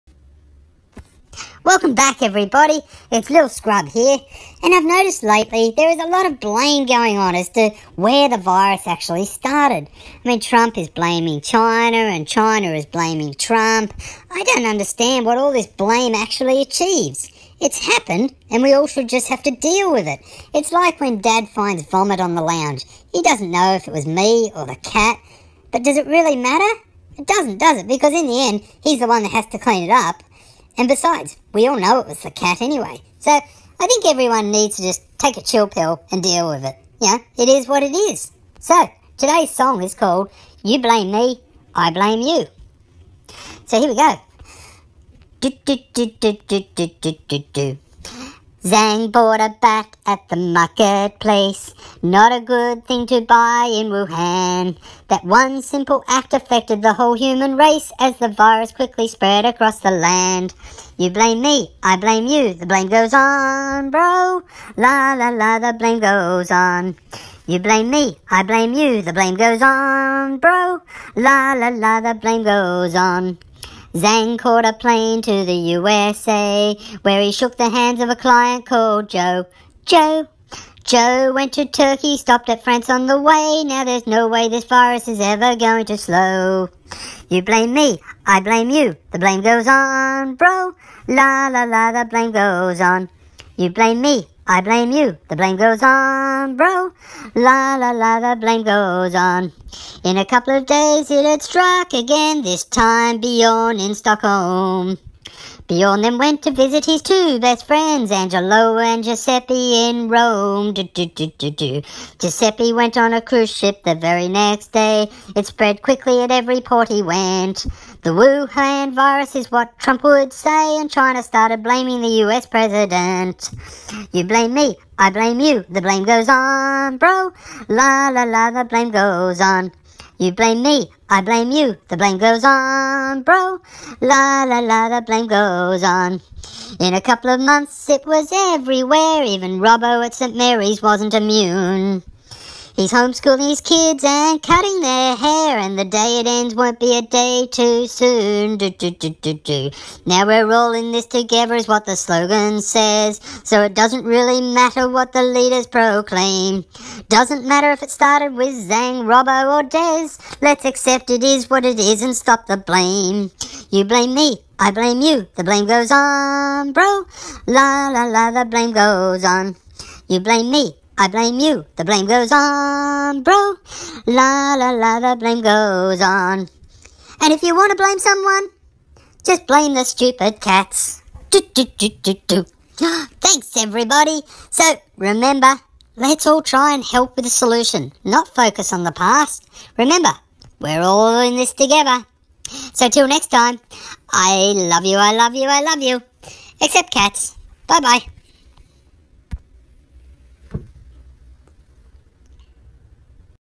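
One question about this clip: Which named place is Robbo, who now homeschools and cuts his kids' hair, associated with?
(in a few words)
St. Mary's.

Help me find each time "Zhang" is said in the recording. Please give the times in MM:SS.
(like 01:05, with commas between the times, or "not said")
00:48, 01:13, 02:38.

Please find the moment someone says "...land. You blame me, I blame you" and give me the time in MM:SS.
00:59.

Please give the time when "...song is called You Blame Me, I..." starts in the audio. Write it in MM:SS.
00:39.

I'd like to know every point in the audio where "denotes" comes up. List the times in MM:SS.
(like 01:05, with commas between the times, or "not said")
not said.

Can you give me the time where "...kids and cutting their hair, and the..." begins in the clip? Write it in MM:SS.
02:23.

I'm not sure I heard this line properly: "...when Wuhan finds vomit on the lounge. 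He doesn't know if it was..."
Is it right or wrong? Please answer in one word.
wrong.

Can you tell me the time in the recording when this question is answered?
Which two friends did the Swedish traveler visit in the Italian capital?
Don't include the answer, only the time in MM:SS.
01:48.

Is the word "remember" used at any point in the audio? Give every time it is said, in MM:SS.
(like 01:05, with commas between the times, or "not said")
03:04, 03:09.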